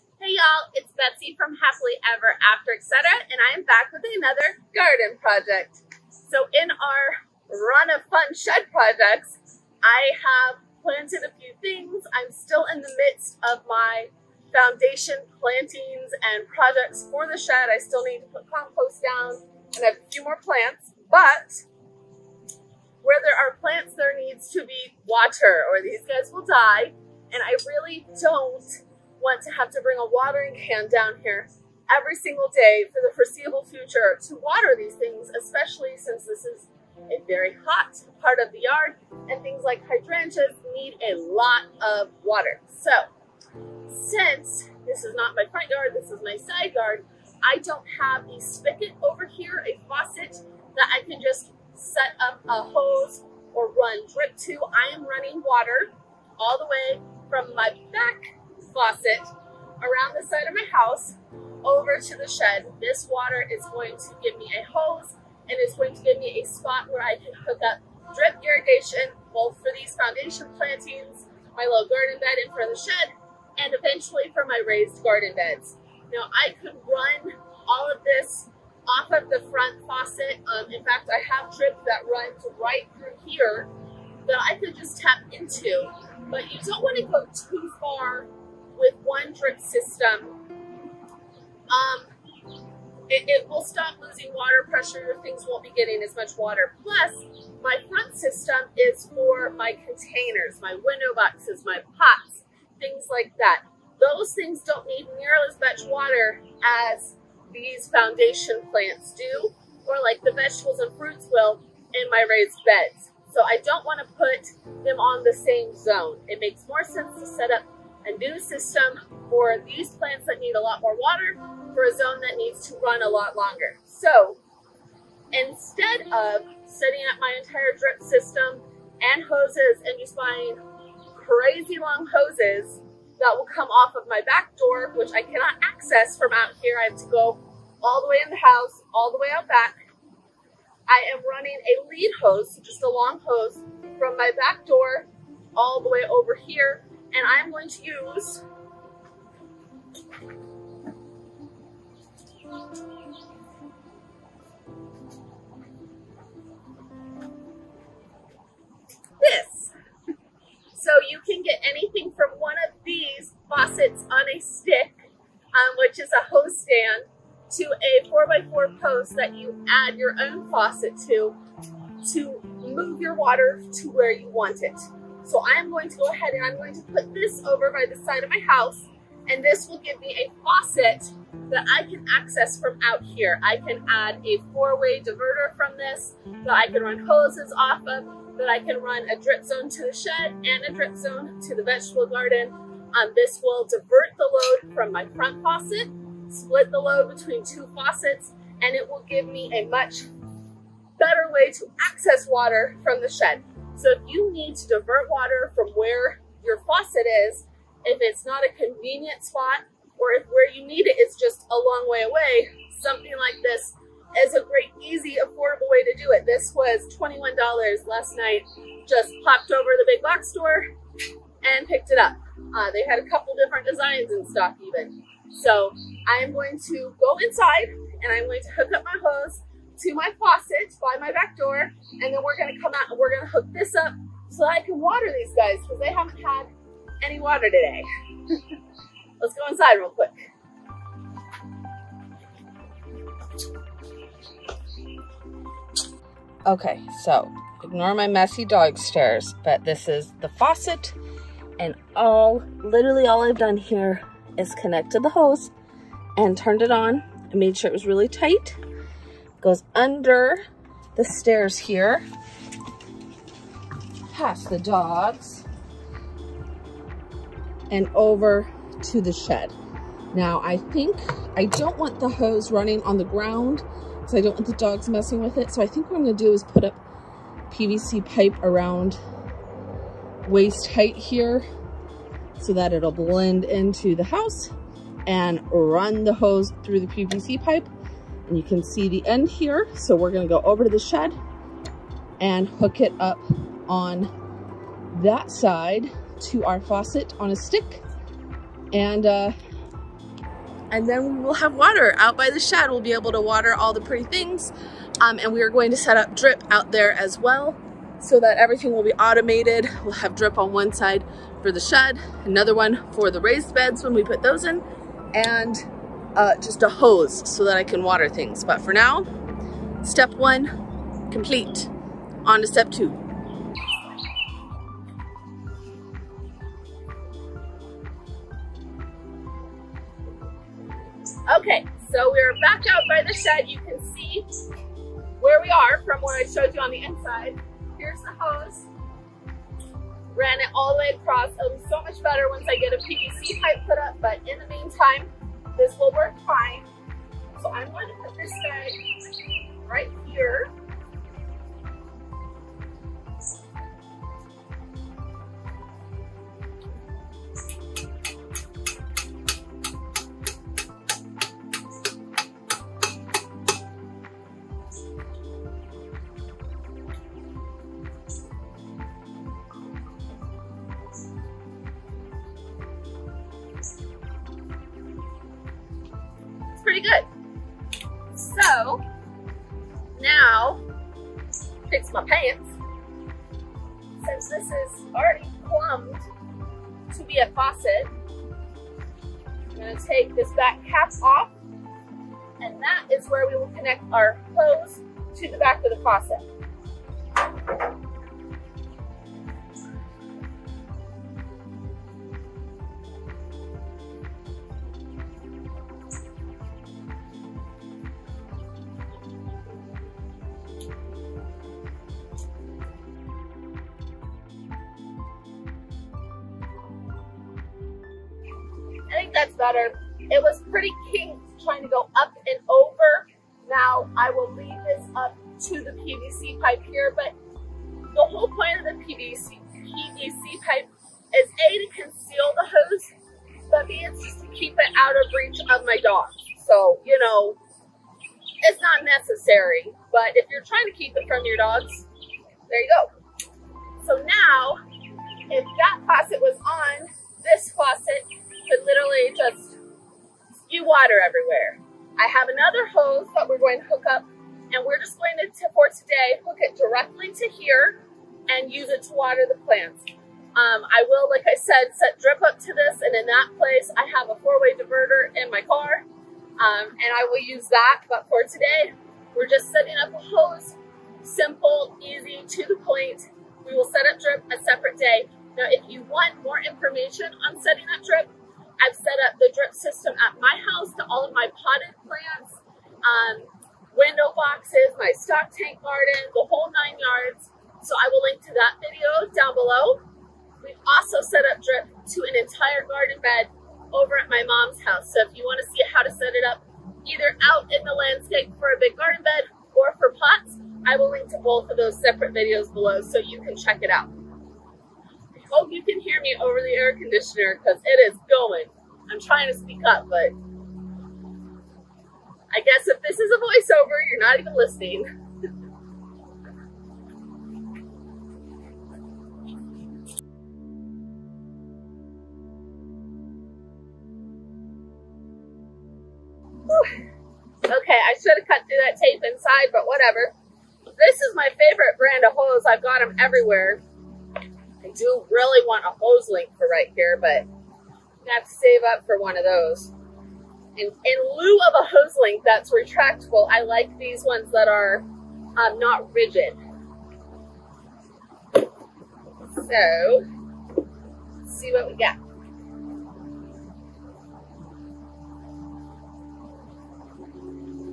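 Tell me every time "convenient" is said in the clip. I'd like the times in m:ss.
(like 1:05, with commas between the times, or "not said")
3:28.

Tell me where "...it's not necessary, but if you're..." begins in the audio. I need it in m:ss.
7:18.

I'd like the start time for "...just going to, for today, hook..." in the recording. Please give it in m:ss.
7:34.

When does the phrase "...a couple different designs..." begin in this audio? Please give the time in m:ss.
3:42.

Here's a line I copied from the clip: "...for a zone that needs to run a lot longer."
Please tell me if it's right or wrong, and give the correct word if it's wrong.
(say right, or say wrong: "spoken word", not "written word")
right.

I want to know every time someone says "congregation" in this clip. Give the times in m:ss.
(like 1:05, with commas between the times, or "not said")
not said.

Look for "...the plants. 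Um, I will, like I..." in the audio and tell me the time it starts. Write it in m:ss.
7:39.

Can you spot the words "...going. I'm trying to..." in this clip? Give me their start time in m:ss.
8:28.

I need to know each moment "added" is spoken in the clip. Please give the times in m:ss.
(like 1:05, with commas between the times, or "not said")
not said.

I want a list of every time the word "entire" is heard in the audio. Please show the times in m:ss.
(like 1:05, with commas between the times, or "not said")
2:07, 8:12.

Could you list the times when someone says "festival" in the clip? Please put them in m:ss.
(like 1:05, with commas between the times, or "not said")
not said.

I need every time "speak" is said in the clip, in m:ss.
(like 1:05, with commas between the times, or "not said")
8:29.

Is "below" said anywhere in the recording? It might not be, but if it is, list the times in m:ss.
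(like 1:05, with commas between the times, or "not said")
8:09, 8:22.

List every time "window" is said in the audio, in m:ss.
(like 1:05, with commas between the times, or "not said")
1:40, 8:03.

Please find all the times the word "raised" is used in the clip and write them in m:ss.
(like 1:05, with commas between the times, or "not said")
1:14, 1:52, 5:13.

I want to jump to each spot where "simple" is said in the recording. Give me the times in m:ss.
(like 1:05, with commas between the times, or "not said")
7:51.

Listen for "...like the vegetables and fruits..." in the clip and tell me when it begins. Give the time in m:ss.
1:50.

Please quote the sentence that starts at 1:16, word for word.
Now I could run all of this off of the front faucet.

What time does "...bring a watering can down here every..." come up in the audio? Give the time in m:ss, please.
0:29.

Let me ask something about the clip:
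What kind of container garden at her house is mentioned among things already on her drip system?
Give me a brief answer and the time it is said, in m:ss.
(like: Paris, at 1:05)
stock tank garden, at 8:04.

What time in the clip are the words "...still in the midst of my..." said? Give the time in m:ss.
0:12.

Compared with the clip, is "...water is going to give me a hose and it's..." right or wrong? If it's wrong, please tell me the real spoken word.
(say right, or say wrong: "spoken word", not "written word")
right.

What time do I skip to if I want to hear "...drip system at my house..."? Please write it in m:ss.
7:59.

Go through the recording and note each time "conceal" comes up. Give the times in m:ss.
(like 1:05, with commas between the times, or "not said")
7:11.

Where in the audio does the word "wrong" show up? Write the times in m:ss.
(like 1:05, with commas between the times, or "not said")
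not said.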